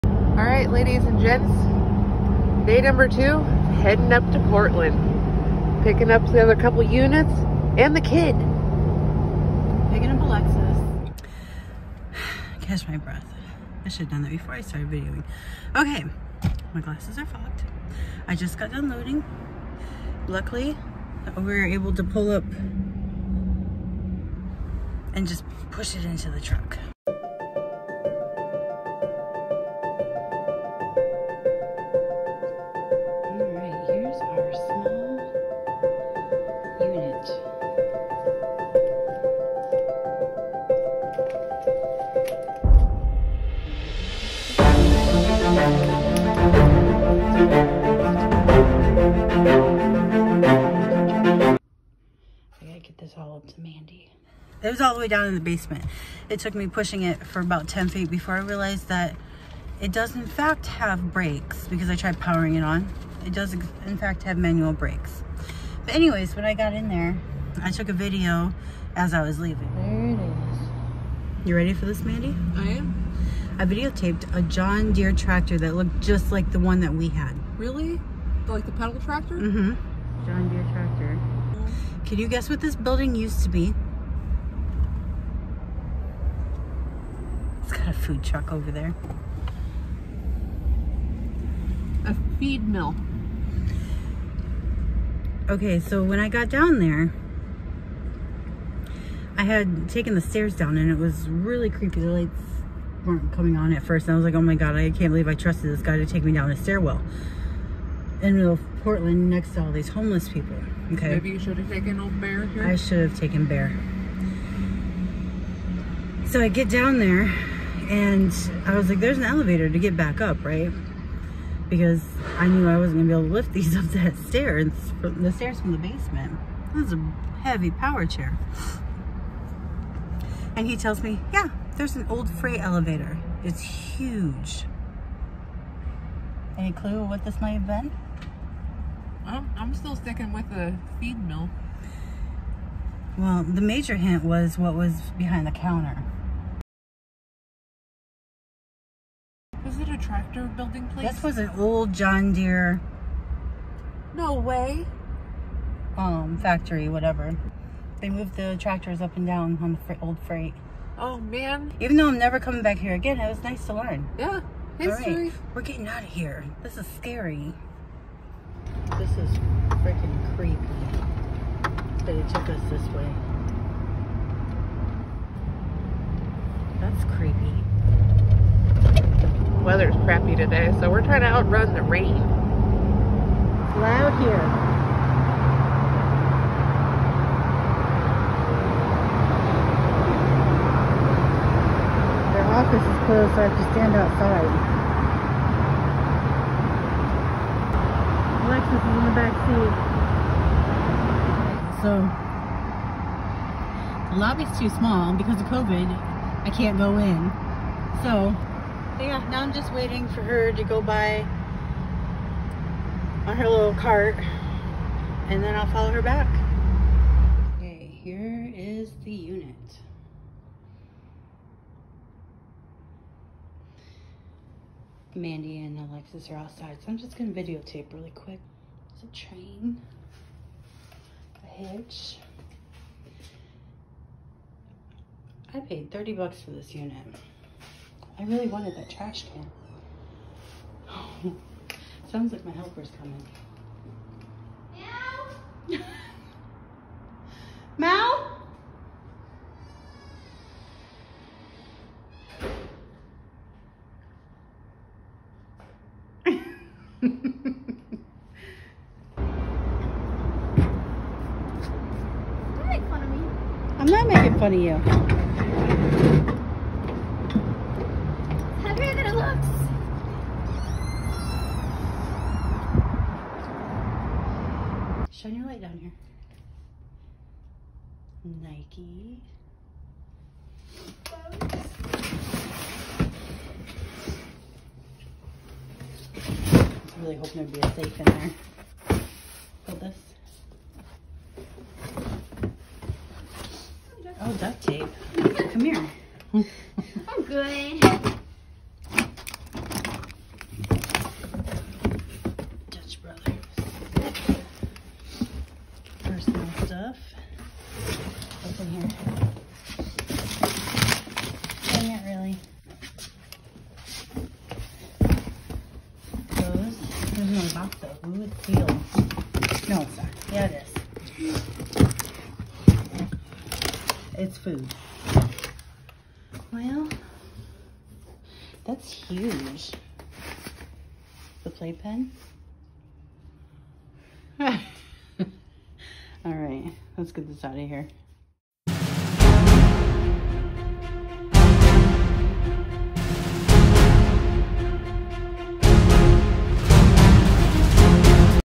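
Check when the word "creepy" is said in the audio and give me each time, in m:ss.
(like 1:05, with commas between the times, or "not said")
1:41, 2:50, 2:57.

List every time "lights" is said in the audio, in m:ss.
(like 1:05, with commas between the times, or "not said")
1:42, 4:35.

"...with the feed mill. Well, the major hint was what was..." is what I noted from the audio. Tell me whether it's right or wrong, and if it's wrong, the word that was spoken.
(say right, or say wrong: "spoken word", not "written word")
right.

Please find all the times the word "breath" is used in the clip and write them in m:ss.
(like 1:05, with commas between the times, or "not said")
0:12.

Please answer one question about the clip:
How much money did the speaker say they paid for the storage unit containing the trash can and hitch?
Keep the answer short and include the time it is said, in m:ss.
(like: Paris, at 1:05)
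$30, at 3:55.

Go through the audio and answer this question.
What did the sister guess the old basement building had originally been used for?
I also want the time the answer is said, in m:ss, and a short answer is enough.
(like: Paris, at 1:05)
A feed mill, at 1:32.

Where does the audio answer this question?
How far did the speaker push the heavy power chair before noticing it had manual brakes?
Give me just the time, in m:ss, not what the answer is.
0:57.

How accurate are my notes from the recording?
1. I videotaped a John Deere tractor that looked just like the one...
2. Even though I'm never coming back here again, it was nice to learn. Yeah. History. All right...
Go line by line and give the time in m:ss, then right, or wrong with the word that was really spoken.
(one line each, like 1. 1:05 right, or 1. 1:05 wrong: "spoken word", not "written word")
1. 1:13 right
2. 2:41 right.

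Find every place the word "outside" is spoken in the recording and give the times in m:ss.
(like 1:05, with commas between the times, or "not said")
3:13, 3:46.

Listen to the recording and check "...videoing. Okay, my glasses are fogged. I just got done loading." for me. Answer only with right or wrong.
right.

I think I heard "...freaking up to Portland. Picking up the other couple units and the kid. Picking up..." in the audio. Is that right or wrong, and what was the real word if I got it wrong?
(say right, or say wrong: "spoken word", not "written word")
wrong: "heading", not "freaking".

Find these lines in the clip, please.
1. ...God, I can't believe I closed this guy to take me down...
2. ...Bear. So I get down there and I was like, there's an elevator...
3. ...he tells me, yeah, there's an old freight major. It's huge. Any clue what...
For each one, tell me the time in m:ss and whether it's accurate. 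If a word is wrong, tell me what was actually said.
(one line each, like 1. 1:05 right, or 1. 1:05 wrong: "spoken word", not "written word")
1. 1:44 wrong: "trusted", not "closed"
2. 1:53 right
3. 2:10 wrong: "elevator", not "major".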